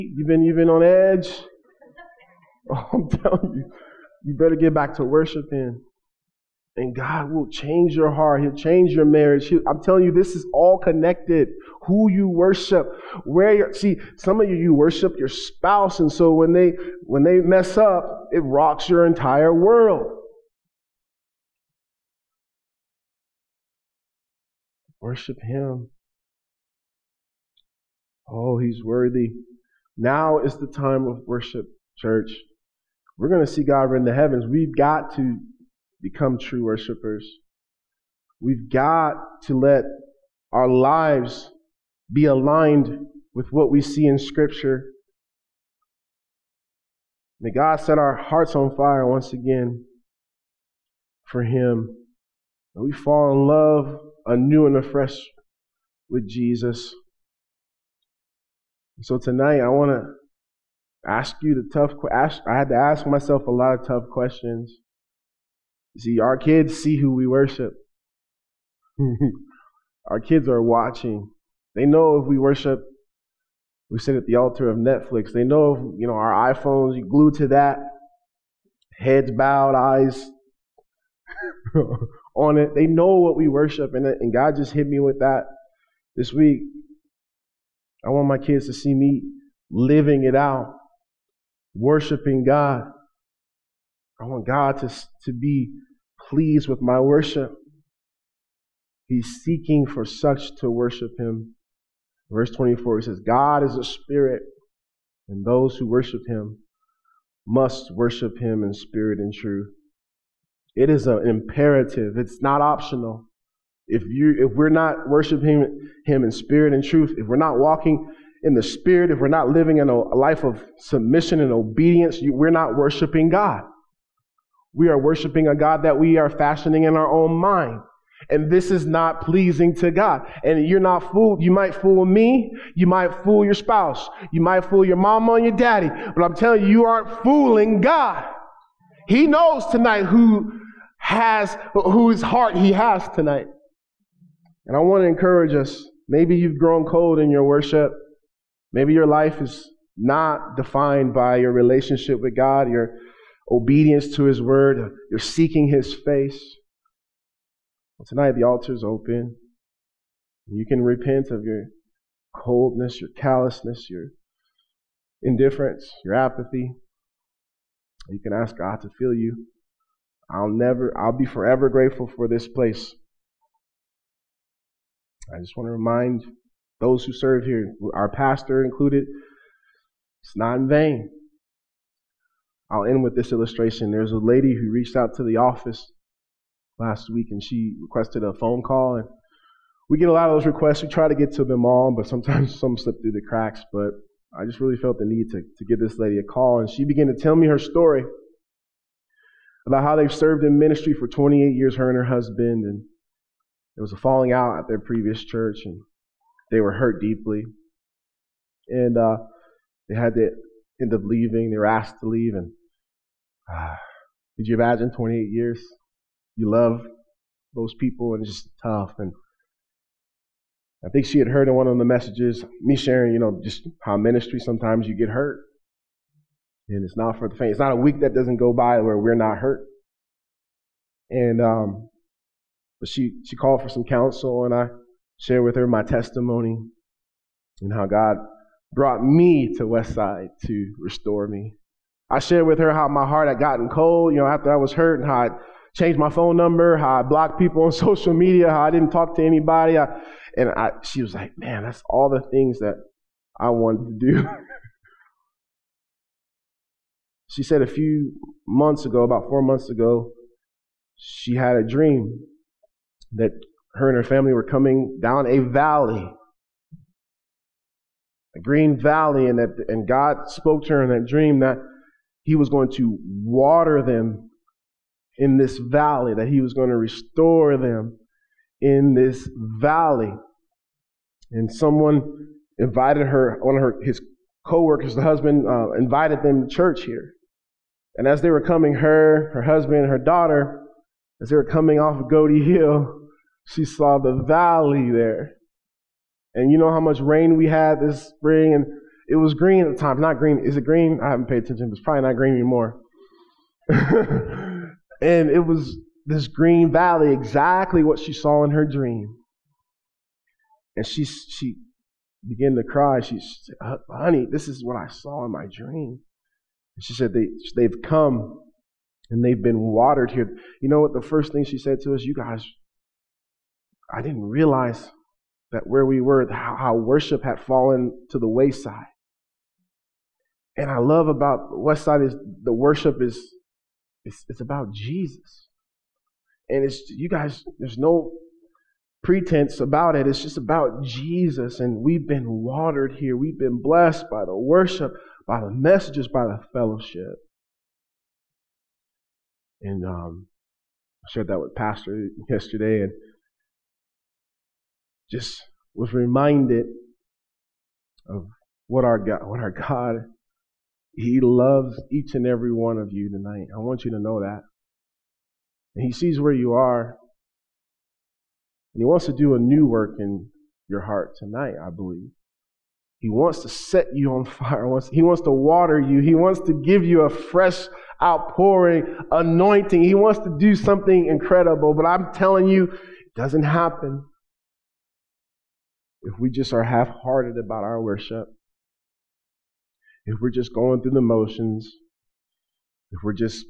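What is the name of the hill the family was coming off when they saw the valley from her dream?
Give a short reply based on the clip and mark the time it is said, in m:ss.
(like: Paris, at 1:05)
Godde Hill, at 4:52.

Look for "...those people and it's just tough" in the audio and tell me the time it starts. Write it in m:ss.
3:37.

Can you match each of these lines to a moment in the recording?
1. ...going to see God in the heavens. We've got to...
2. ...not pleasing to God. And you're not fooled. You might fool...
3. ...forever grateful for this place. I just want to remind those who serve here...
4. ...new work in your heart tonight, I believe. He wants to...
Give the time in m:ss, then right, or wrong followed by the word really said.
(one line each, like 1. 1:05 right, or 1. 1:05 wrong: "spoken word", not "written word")
1. 0:33 right
2. 2:08 right
3. 2:51 right
4. 6:09 right.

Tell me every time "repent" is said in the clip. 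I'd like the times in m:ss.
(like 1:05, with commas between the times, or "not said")
2:40.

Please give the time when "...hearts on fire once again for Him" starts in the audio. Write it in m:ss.
0:48.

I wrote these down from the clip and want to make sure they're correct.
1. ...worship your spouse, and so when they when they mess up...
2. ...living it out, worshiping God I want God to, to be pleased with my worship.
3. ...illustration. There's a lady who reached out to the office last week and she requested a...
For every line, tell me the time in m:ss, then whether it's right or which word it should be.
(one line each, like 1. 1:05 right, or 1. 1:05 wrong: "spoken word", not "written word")
1. 0:14 right
2. 1:29 right
3. 3:03 right.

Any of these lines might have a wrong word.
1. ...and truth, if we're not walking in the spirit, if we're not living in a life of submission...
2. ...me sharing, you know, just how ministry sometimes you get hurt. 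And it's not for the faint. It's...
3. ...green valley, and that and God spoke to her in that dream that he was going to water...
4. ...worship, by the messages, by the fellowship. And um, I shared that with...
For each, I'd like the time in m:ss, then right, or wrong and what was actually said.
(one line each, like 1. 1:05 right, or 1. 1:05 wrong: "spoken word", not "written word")
1. 1:56 right
2. 3:42 right
3. 4:28 right
4. 5:44 right.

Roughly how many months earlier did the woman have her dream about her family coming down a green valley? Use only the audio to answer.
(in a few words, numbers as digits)
4.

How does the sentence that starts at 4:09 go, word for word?
I, and I, she was like, man, that's all the things that I wanted to do.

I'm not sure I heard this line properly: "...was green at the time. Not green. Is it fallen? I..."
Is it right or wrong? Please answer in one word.
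wrong.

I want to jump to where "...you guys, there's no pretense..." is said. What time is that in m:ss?
5:36.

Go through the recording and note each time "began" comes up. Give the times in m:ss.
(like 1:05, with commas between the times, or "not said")
3:16, 5:12.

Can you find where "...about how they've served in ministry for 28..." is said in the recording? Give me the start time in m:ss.
3:19.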